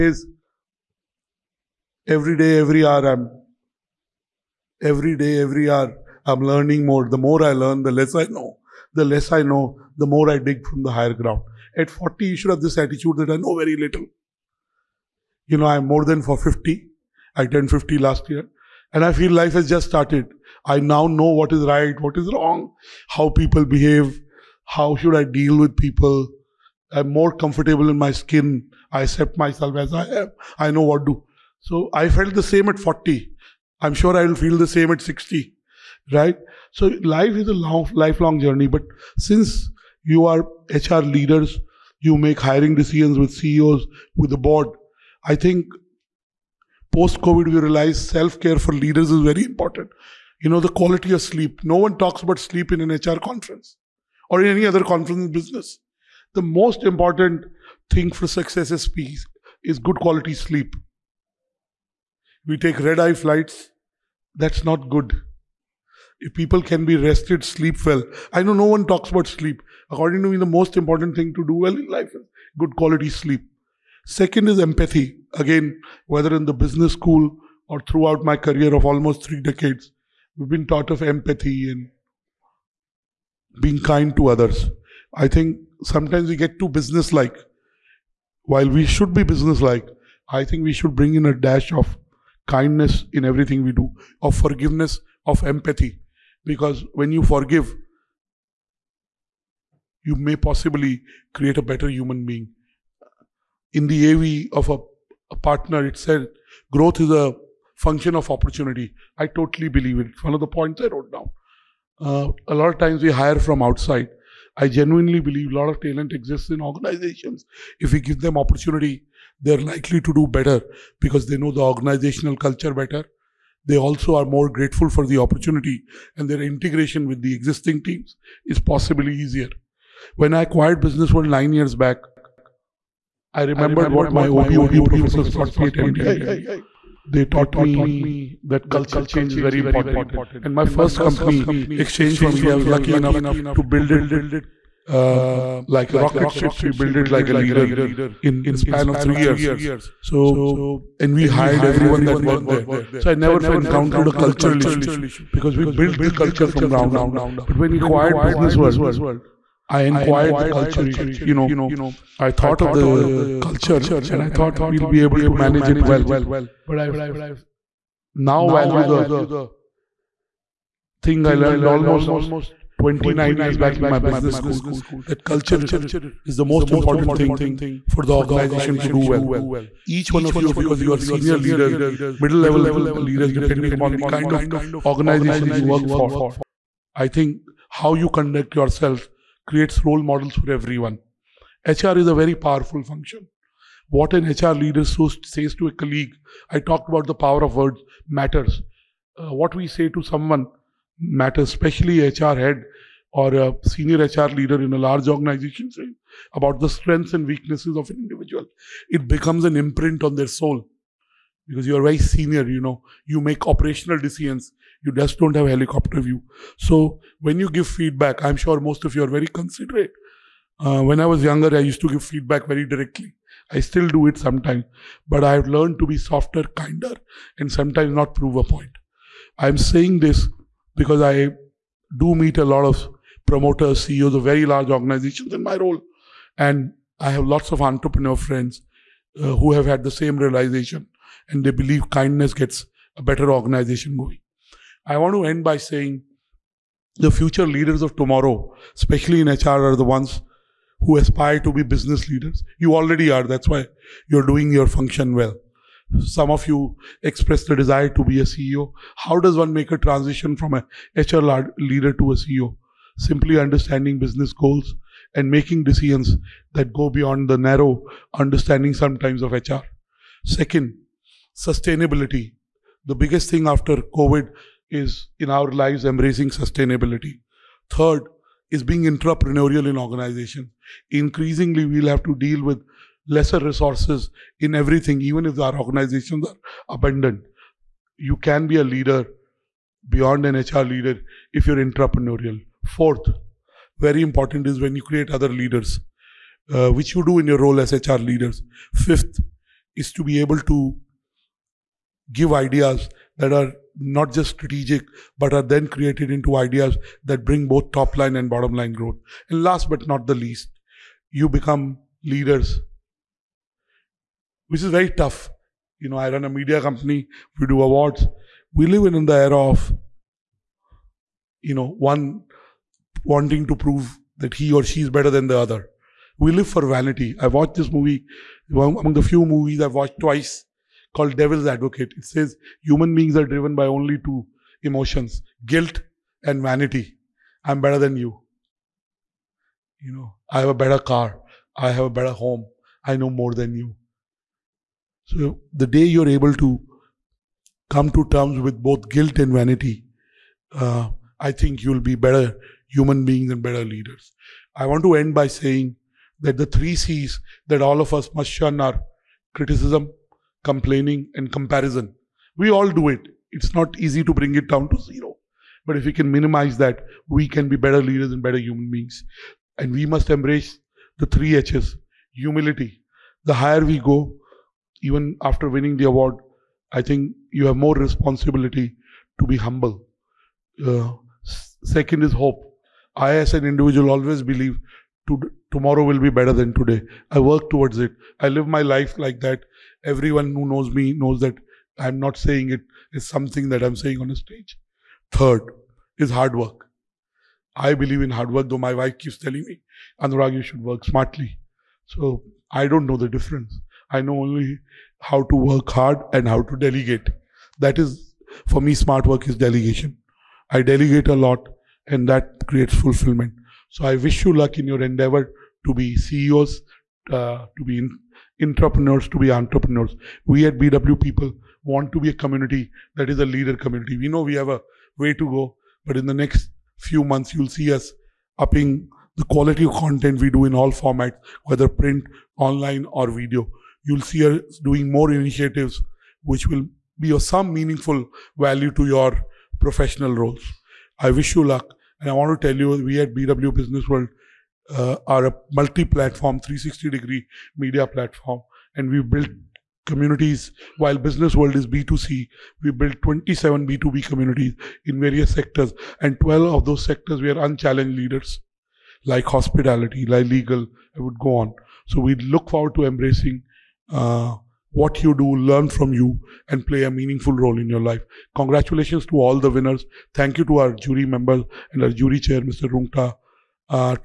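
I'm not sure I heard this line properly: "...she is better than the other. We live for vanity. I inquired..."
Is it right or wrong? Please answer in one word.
wrong.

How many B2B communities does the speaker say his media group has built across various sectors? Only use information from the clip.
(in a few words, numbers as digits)
27.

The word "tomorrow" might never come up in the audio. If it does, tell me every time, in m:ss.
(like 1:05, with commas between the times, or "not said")
4:07, 6:25.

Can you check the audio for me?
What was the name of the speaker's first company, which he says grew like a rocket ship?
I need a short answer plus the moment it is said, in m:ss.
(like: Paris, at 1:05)
exchange4media, at 2:21.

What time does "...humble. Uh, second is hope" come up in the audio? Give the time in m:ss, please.
6:19.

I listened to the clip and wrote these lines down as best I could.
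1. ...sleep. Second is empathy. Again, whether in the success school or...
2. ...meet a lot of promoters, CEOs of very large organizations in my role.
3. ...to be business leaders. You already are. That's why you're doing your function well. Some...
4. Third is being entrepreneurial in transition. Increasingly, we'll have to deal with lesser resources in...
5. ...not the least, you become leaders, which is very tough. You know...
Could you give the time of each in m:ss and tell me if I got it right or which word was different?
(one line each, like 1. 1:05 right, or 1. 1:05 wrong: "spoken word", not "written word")
1. 1:13 wrong: "business", not "success"
2. 3:52 right
3. 4:11 right
4. 4:37 wrong: "organization", not "transition"
5. 5:09 right.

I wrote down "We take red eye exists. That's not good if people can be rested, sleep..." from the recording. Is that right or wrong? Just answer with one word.
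wrong.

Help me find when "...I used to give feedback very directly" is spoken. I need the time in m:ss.
3:41.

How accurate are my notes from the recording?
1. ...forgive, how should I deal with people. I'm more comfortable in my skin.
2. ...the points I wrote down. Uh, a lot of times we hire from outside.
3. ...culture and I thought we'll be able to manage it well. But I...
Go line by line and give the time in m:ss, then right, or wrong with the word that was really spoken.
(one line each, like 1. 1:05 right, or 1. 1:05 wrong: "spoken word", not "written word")
1. 0:23 wrong: "behave", not "forgive"
2. 1:50 right
3. 2:43 right.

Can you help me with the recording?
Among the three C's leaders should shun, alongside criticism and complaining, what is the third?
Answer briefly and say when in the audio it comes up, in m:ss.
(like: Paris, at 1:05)
comparison, at 6:01.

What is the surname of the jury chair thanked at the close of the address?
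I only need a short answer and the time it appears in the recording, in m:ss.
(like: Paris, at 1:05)
Rungta, at 7:52.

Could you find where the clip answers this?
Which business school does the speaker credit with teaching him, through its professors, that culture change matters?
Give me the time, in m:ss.
2:15.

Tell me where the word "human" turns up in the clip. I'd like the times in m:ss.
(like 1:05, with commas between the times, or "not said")
1:41, 5:32, 5:52, 6:08.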